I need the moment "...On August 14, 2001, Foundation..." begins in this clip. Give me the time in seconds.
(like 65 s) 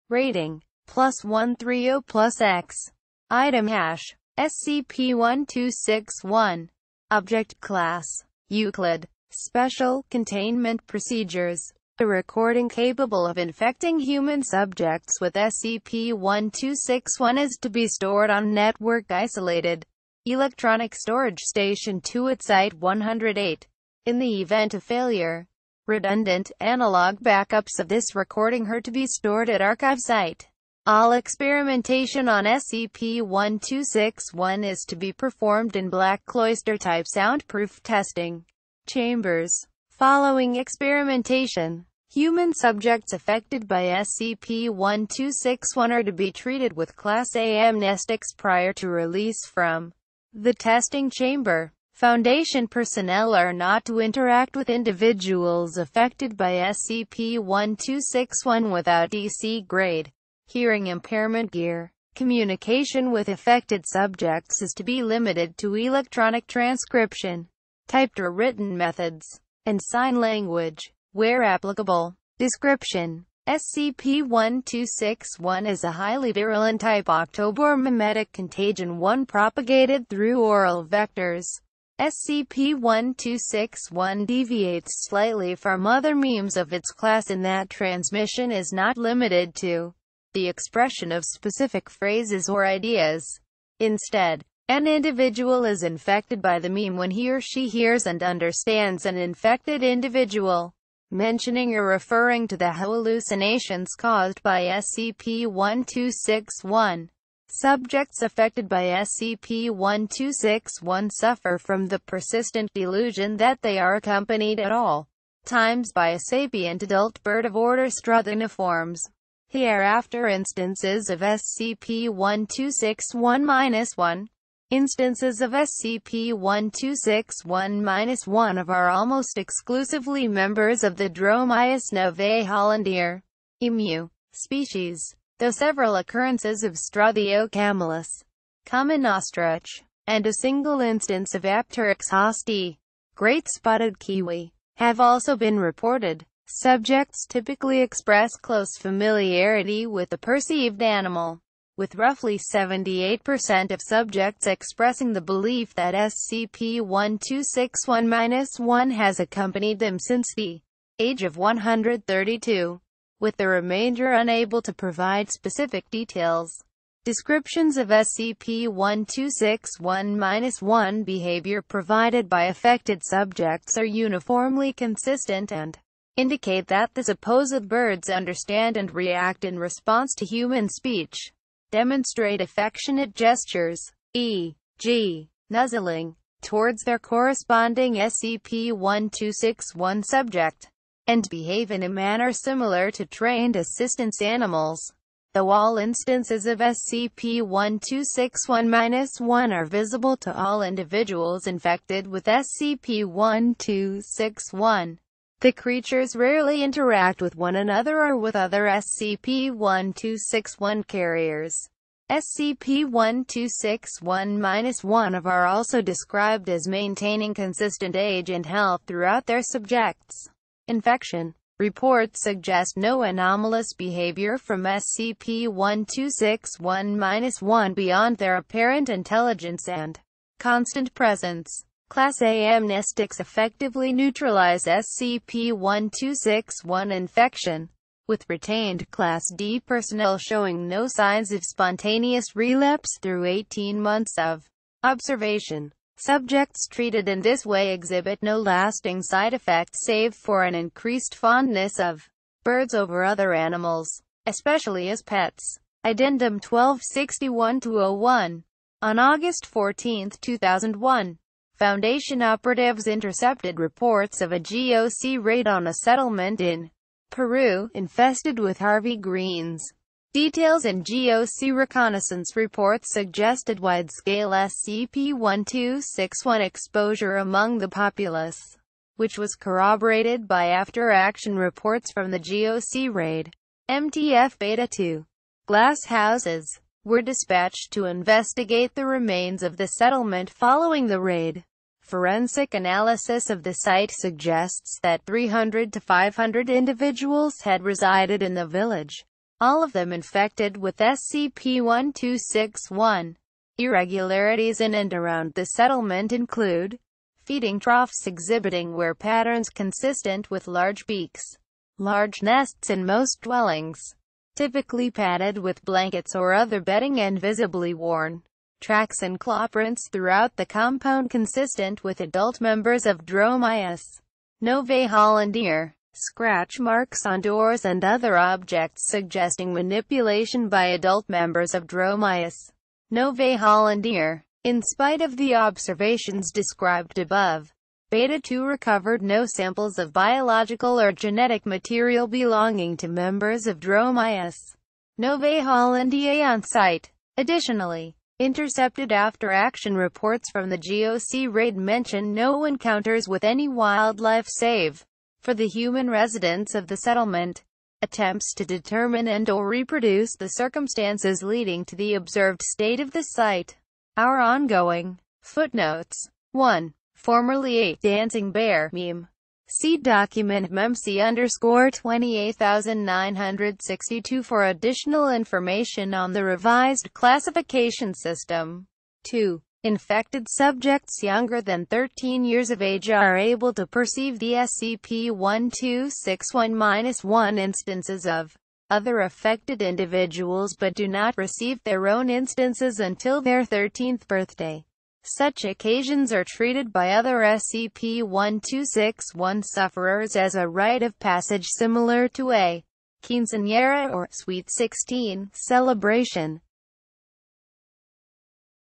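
258 s.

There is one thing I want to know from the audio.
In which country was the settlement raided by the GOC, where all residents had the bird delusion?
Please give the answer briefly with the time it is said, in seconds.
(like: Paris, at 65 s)
Peru, at 267 s.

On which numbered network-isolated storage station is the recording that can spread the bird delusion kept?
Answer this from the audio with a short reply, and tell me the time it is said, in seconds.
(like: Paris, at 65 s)
Storage station 2, at 20 s.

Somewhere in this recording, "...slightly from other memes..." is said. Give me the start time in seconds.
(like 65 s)
85 s.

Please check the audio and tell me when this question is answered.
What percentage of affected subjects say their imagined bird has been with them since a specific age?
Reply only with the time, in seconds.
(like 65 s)
152 s.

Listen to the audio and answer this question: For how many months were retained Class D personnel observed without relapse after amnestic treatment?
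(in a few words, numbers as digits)
18 months.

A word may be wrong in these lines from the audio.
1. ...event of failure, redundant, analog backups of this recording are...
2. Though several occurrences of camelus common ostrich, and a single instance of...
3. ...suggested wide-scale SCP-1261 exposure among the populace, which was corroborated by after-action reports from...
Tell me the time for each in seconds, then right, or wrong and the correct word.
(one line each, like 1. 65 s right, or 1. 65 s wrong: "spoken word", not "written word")
1. 24 s right
2. 135 s right
3. 272 s right.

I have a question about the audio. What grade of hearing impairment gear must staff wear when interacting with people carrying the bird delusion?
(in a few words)
DC grade.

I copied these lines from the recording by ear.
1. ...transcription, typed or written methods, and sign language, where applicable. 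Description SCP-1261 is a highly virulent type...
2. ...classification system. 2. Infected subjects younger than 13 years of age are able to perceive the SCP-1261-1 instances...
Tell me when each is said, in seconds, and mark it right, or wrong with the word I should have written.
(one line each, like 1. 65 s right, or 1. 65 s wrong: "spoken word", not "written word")
1. 66 s right
2. 376 s right.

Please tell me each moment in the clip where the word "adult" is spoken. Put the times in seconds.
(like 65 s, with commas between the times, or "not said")
116 s, 321 s, 330 s.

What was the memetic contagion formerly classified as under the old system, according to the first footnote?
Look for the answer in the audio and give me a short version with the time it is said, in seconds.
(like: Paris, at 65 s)
Dancing bear meme, at 367 s.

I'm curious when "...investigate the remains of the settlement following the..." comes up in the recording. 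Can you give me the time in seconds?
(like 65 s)
287 s.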